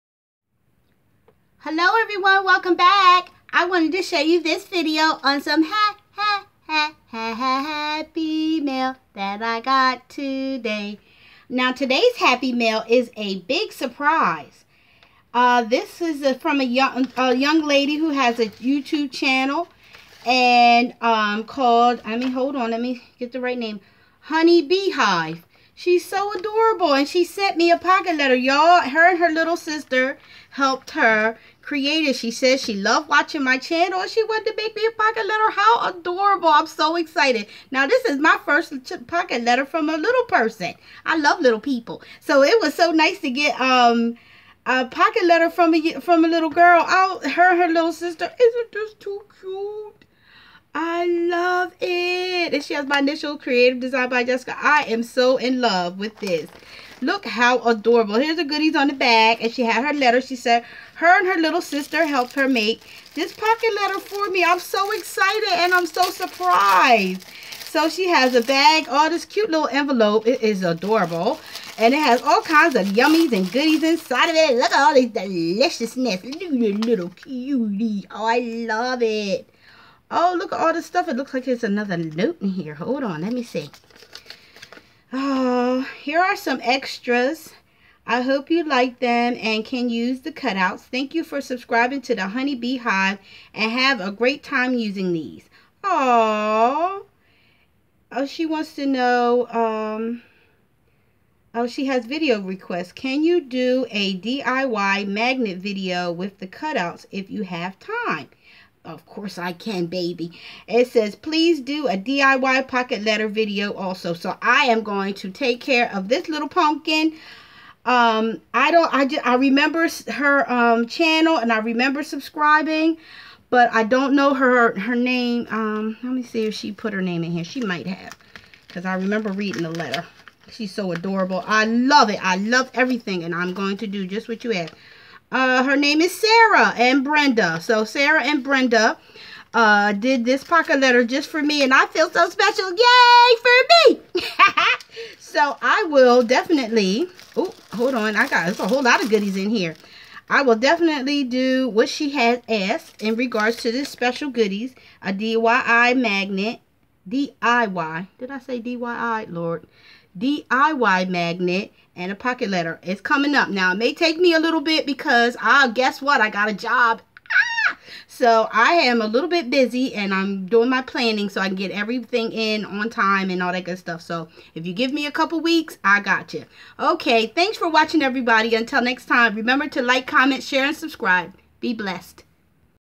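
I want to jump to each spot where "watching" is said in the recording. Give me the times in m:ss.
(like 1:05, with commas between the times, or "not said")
0:33, 2:57.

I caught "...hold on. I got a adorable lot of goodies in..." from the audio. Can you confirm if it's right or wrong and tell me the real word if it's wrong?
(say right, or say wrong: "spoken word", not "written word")
wrong: "whole", not "adorable".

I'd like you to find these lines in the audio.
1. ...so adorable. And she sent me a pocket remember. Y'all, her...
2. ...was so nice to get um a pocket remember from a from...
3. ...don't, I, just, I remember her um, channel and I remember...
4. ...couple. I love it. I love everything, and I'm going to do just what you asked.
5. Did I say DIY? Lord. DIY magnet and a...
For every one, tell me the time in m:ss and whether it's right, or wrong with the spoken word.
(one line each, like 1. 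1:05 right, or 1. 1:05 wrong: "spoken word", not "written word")
1. 0:26 wrong: "letter", not "remember"
2. 0:42 wrong: "letter", not "remember"
3. 1:58 right
4. 2:10 wrong: "adorable", not "couple"
5. 2:38 right.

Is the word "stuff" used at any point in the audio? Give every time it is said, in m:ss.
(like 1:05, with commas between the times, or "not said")
1:20, 2:53.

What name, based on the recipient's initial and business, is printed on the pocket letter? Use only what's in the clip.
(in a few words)
Creative Design by Jessica.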